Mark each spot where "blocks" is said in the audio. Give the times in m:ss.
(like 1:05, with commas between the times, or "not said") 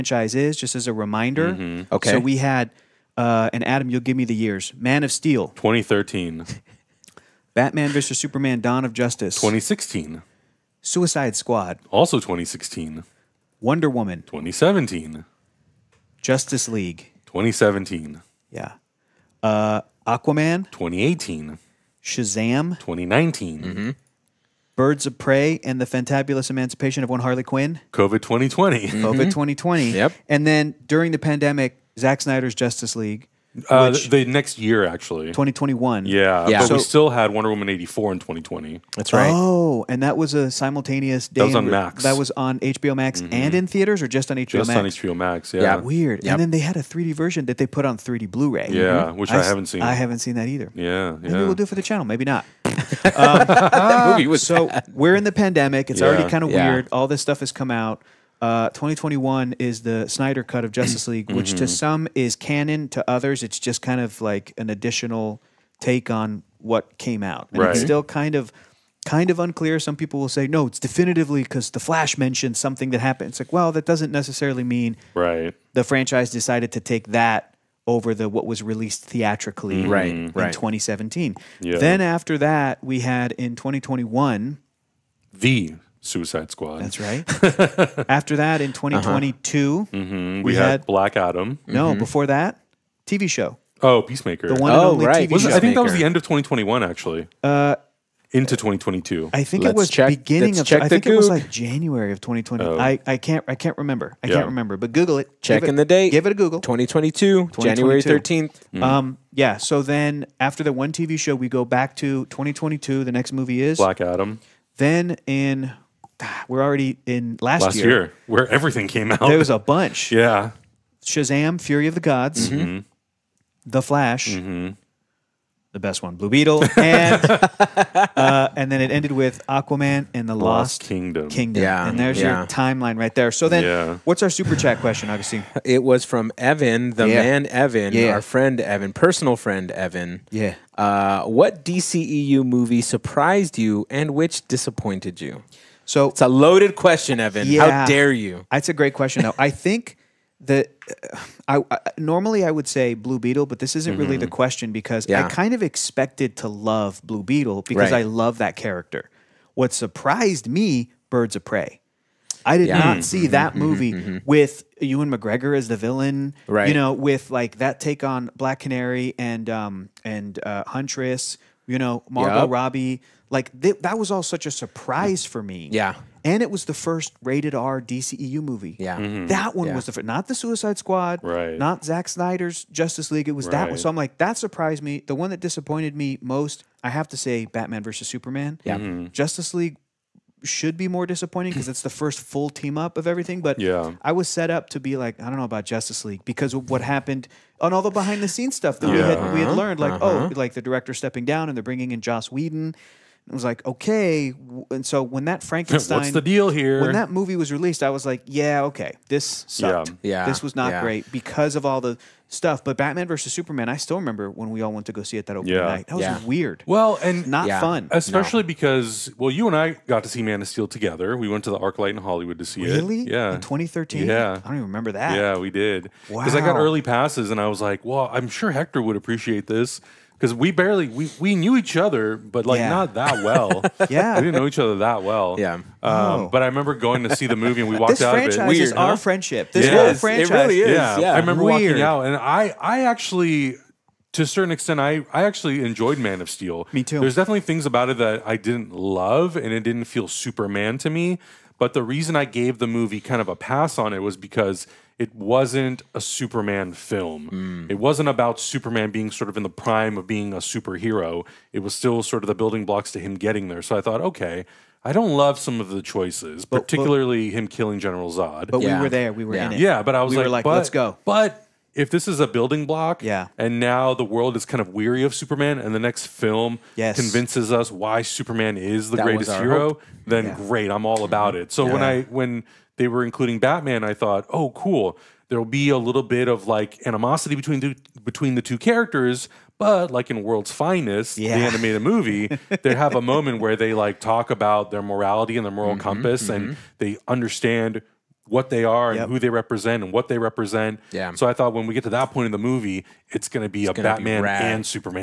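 4:22, 4:32.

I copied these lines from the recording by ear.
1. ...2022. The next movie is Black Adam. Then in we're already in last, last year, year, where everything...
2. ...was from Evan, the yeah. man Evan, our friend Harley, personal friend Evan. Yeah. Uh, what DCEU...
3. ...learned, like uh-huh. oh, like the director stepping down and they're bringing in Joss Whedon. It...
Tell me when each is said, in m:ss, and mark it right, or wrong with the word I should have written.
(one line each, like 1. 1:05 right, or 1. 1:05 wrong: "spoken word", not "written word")
1. 1:52 right
2. 2:15 wrong: "Evan", not "Harley"
3. 3:19 right.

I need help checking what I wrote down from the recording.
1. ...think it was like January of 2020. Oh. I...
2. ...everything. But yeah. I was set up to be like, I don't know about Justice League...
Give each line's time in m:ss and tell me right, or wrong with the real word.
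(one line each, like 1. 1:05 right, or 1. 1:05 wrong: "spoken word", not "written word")
1. 1:40 right
2. 3:13 right.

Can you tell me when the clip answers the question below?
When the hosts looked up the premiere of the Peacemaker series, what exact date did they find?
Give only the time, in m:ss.
1:47.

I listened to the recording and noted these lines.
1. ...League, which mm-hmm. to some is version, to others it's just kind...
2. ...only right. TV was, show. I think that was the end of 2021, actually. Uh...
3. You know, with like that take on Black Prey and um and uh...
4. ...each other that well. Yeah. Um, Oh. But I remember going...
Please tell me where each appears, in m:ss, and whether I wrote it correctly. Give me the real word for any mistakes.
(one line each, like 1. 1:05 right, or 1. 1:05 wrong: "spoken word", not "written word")
1. 1:01 wrong: "canon", not "version"
2. 1:34 right
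3. 2:46 wrong: "Canary", not "Prey"
4. 3:54 right.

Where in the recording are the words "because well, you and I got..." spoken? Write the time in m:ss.
3:38.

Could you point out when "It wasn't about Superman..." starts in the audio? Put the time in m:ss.
4:17.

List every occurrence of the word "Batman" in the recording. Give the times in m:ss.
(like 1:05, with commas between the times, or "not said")
0:07, 3:07, 3:32, 4:43, 5:03.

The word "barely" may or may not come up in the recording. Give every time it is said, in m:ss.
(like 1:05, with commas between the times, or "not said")
3:50.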